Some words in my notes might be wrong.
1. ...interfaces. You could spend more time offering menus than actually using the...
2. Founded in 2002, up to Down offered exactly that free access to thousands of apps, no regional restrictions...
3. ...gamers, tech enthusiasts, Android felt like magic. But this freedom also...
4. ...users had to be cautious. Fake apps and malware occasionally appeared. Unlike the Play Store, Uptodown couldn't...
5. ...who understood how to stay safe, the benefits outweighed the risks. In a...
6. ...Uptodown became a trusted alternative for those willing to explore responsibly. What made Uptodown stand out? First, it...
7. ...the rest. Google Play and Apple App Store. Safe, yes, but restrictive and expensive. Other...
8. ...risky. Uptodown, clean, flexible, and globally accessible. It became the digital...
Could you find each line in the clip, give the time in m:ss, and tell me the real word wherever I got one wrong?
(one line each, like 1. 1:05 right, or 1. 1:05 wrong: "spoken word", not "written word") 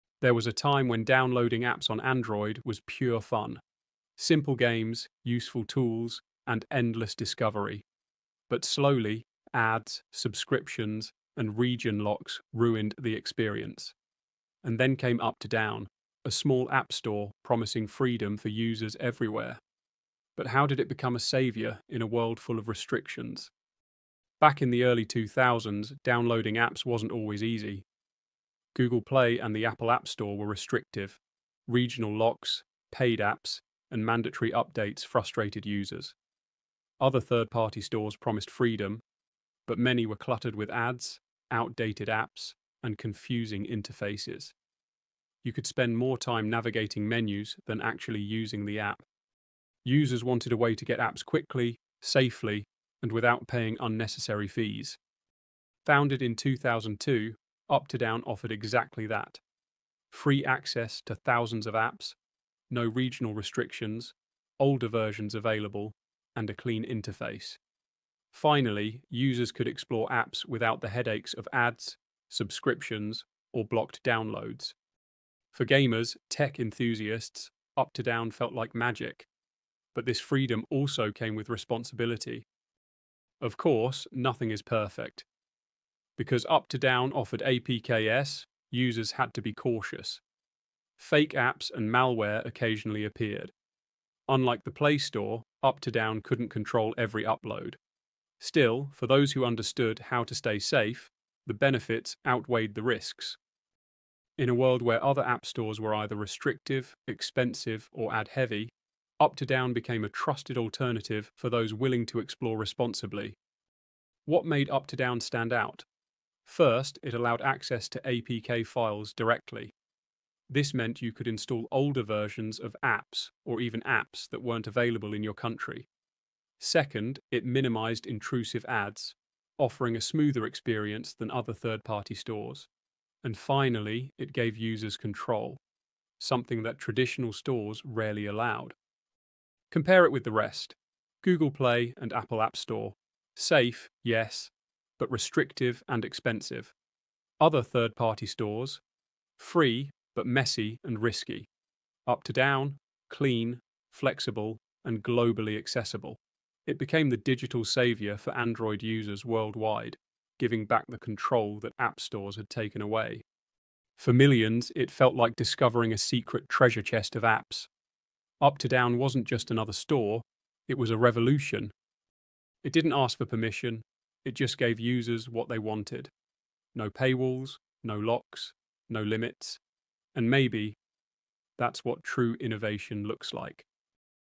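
1. 0:43 wrong: "navigating", not "offering"
2. 0:55 right
3. 1:15 wrong: "Uptodown", not "Android"
4. 1:28 right
5. 1:39 right
6. 1:49 right
7. 2:20 right
8. 2:31 right.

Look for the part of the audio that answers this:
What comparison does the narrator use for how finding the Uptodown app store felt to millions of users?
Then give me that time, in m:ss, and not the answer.
2:45.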